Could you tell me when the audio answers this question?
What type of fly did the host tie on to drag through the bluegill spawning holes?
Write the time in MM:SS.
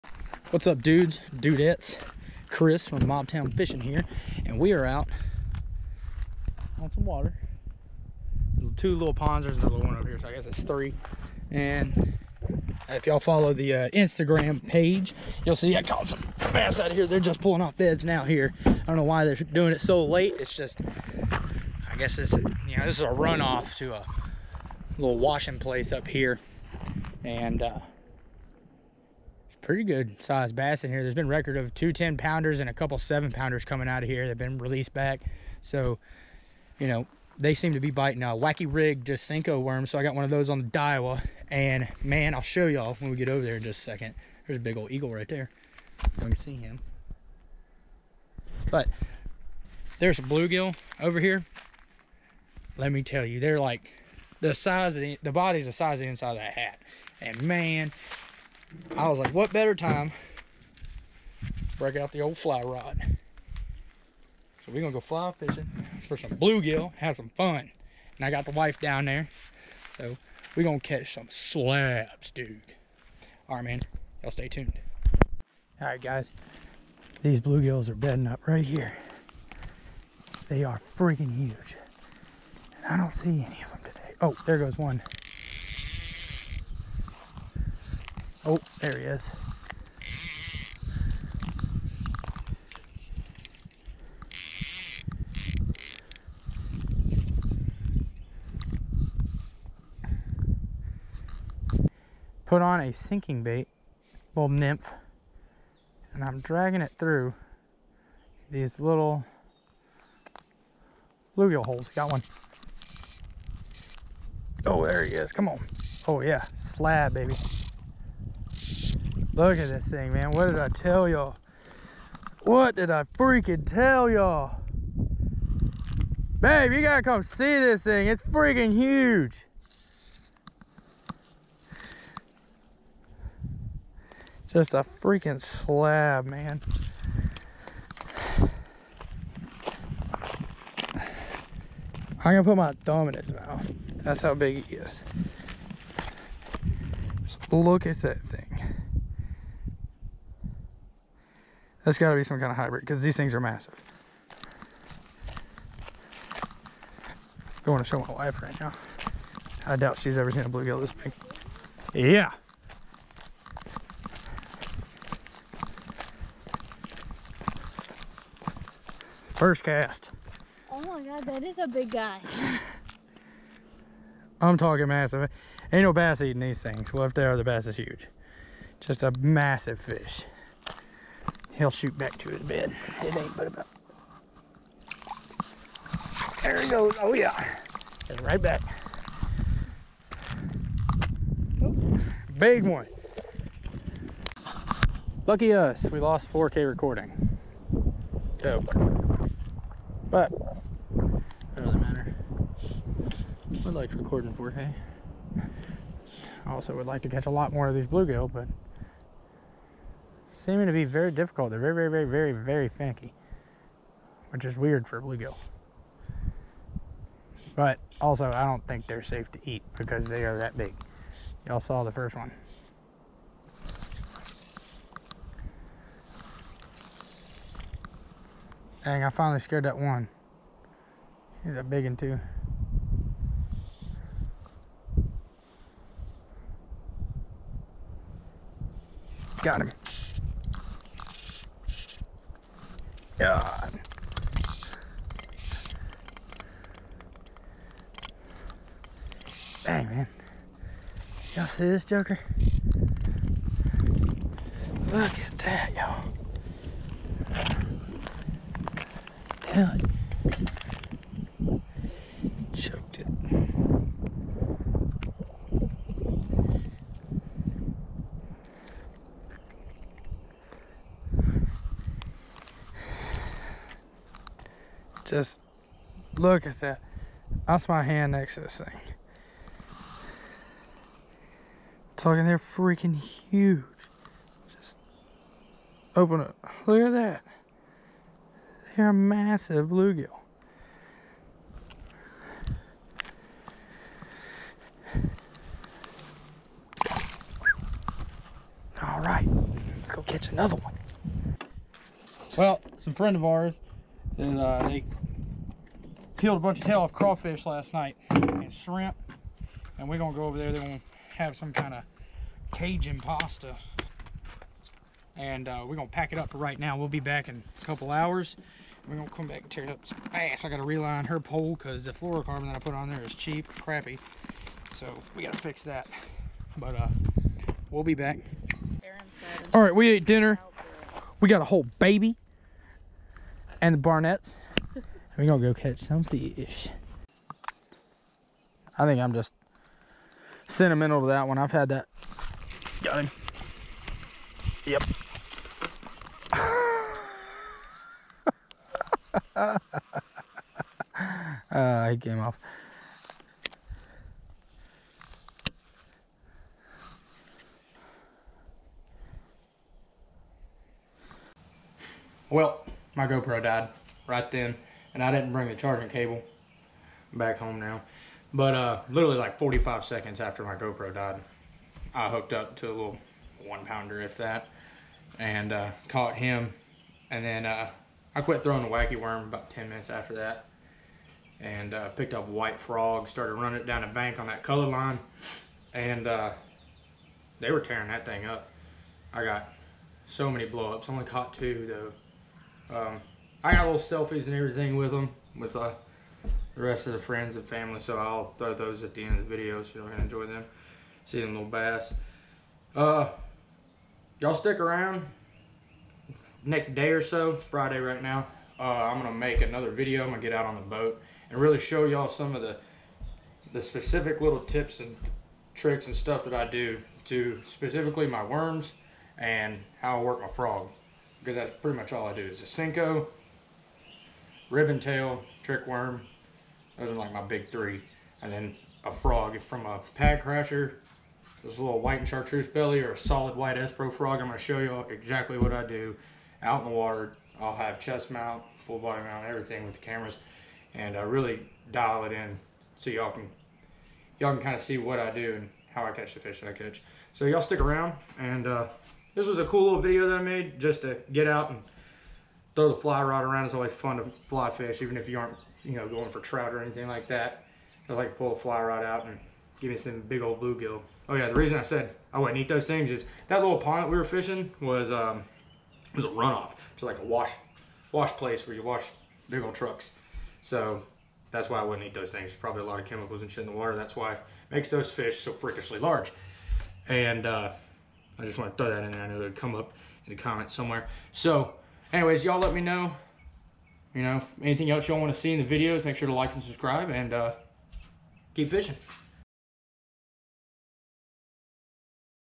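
01:44.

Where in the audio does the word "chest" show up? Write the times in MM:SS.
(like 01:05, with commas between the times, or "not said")
07:17.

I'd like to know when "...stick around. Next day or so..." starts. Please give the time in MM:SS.
06:44.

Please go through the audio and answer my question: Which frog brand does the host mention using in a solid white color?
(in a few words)
SPRO.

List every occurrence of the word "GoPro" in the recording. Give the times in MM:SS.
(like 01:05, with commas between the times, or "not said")
06:03, 06:10.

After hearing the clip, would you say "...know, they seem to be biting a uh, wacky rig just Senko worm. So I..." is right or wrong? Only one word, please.
right.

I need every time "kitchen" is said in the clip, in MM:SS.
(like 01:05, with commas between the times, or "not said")
not said.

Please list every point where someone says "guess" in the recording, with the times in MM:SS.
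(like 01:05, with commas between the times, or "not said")
00:10, 00:21.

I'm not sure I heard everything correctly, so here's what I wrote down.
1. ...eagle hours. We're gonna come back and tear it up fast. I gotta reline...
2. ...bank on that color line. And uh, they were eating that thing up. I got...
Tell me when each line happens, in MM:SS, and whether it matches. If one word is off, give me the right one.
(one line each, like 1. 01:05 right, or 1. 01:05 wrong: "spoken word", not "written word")
1. 05:17 wrong: "couple", not "eagle"
2. 06:23 wrong: "tearing", not "eating".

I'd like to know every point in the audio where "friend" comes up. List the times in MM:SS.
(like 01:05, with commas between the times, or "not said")
05:02, 06:36.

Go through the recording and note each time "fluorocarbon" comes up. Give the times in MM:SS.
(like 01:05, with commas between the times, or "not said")
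05:21.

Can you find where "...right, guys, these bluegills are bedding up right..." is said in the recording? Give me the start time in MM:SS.
01:15.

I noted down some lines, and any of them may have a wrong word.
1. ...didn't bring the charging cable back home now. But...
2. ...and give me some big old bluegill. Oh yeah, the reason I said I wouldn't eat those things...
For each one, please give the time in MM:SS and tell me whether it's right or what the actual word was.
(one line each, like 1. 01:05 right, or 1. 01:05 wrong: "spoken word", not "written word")
1. 06:05 right
2. 07:39 right.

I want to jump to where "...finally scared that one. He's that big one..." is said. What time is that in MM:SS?
03:49.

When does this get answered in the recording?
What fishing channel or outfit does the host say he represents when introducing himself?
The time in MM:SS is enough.
00:03.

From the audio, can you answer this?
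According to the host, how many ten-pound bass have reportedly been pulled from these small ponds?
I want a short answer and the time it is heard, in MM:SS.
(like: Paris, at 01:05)
2, at 00:31.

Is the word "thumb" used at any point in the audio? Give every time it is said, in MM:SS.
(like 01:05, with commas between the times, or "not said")
02:22.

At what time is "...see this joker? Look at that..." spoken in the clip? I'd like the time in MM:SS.
04:11.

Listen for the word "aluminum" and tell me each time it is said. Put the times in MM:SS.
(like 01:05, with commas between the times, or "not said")
not said.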